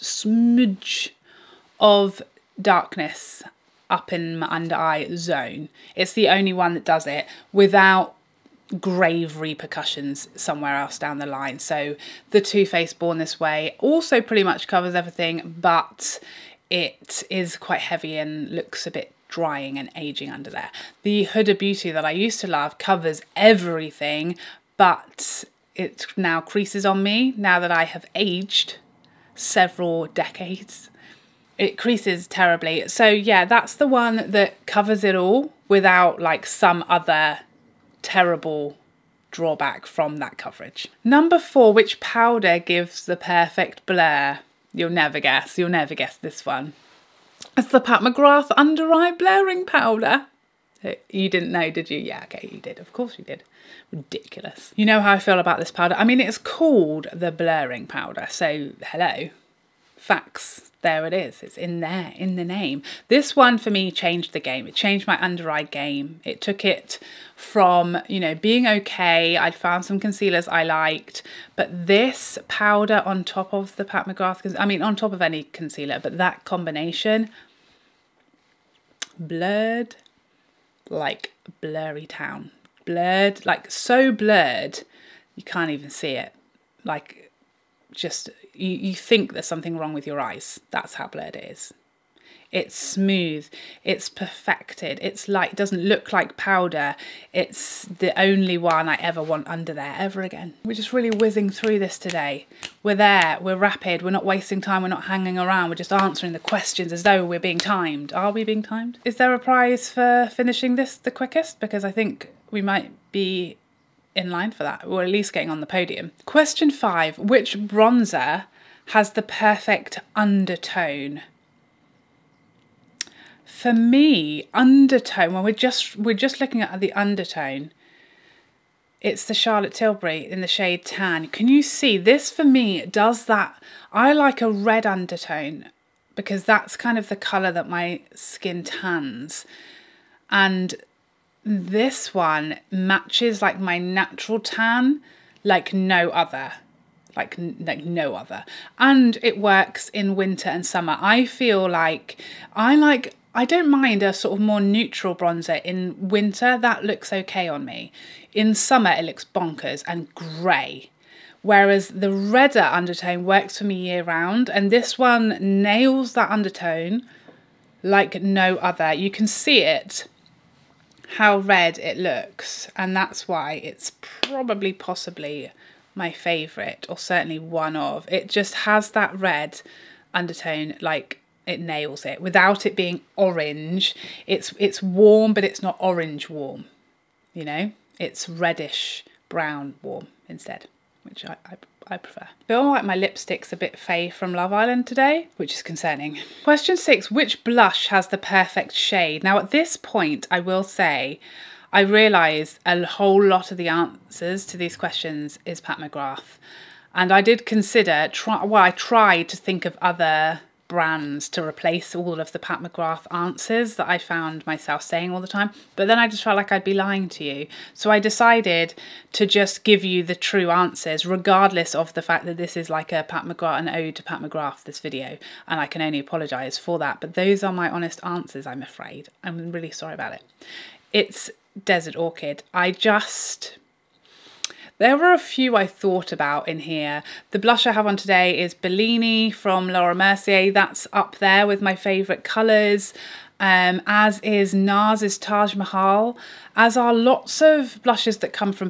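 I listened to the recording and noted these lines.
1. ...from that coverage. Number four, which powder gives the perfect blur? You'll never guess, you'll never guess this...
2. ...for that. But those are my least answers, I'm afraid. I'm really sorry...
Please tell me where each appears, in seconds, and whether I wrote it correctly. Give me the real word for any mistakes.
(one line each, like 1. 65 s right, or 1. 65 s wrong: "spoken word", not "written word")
1. 39 s right
2. 226 s wrong: "honest", not "least".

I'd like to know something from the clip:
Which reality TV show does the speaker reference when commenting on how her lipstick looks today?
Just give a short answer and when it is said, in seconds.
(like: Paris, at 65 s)
Love Island, at 194 s.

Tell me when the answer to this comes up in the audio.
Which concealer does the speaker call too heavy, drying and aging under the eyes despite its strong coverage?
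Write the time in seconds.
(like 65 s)
12 s.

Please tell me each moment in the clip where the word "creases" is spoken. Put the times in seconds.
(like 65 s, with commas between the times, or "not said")
26 s, 31 s.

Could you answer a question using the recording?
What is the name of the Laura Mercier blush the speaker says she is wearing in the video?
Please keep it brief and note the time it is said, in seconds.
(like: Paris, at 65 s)
Bellini, at 238 s.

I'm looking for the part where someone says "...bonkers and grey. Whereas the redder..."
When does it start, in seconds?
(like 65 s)
159 s.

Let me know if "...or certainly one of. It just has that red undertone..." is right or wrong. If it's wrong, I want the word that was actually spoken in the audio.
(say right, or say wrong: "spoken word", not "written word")
right.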